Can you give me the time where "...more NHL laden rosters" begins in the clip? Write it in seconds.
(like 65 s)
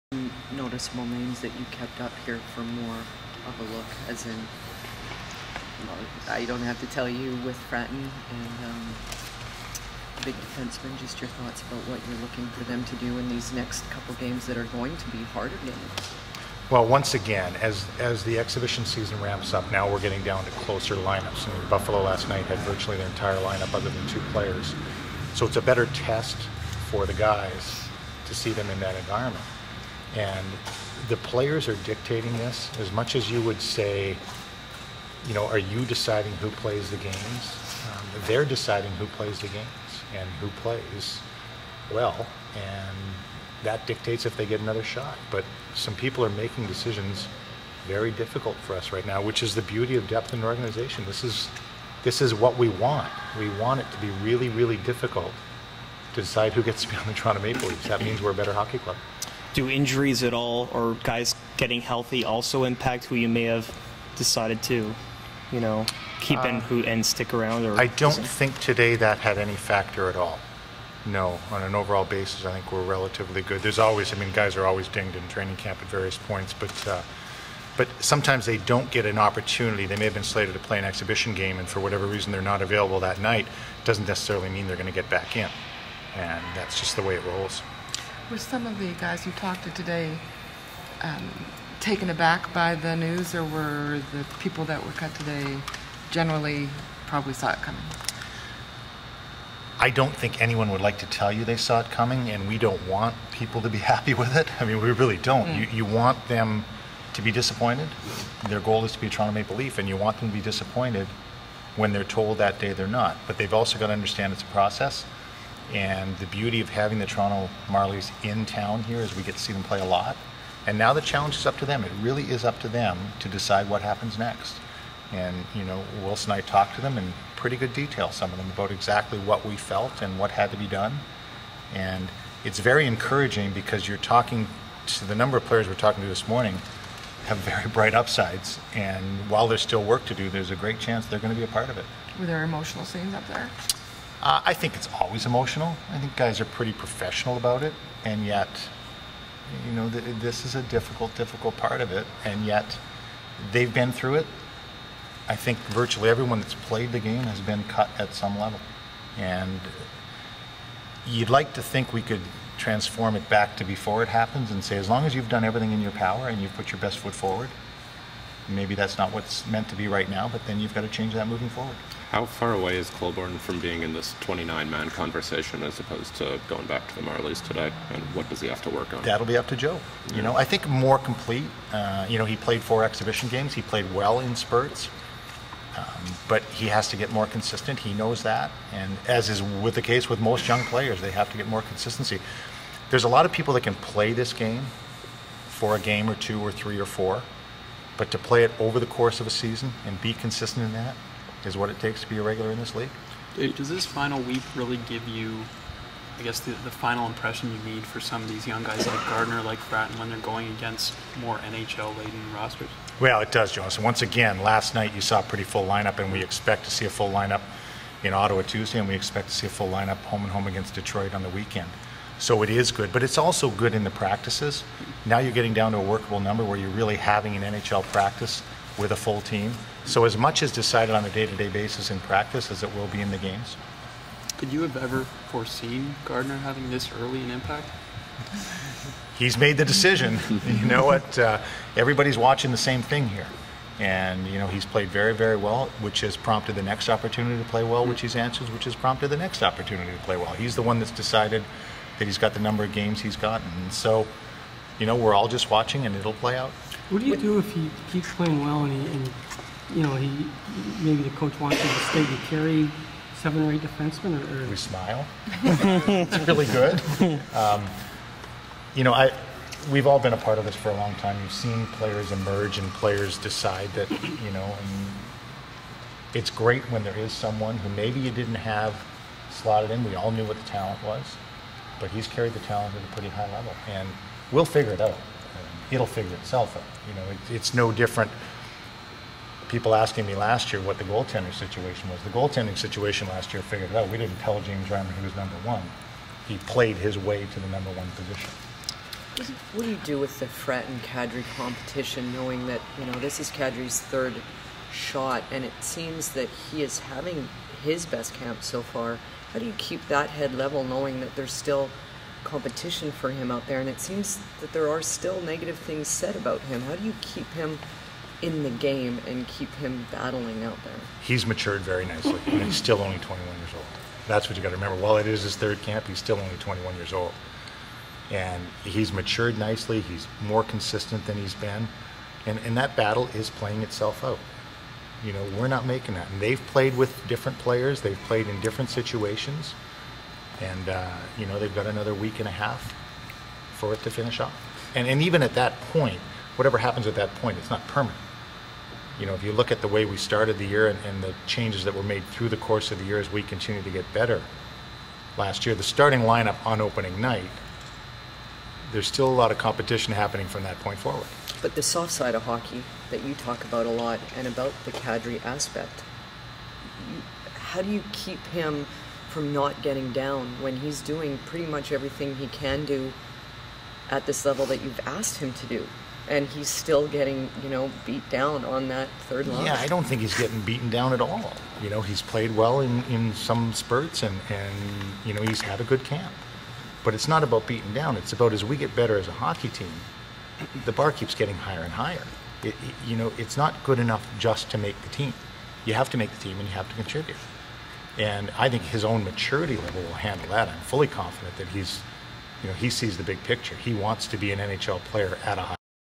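211 s.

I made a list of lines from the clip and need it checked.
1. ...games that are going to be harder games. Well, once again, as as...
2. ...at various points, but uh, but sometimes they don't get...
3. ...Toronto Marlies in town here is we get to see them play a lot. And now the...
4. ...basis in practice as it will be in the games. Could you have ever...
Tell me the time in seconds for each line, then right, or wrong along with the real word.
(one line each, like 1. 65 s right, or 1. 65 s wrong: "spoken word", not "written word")
1. 14 s right
2. 75 s right
3. 117 s right
4. 231 s right.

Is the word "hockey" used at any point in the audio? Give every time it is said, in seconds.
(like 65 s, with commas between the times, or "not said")
58 s, 362 s, 389 s.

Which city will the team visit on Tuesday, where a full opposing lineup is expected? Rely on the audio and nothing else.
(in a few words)
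Ottawa.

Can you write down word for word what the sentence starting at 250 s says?
He's the one that's decided that he's got the number of games he's gotten.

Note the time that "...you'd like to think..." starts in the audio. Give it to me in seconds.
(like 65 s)
161 s.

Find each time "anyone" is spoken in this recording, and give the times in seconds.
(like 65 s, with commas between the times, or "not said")
100 s.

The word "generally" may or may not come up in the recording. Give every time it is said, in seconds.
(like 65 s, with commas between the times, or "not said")
96 s.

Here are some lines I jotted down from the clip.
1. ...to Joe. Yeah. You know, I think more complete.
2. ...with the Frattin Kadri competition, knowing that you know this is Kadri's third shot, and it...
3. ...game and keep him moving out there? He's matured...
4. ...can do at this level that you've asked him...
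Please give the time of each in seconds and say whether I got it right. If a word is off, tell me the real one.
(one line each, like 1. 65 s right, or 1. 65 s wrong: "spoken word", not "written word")
1. 179 s right
2. 299 s right
3. 318 s wrong: "battling", not "moving"
4. 372 s right.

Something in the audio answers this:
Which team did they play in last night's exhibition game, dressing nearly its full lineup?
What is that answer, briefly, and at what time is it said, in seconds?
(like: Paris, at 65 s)
Buffalo, at 21 s.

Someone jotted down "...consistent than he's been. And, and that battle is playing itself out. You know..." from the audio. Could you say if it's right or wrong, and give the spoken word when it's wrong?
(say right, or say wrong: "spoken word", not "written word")
right.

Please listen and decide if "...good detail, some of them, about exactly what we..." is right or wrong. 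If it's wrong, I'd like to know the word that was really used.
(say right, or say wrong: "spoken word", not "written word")
right.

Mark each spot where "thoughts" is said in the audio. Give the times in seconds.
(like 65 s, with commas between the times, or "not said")
11 s.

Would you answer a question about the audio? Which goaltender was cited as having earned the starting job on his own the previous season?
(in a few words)
James Reimer.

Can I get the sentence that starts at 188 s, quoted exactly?
And as is with the case with most young players, they have to get more consistency.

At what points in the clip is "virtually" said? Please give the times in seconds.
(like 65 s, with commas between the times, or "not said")
22 s, 155 s.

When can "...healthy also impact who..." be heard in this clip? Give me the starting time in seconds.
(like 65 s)
61 s.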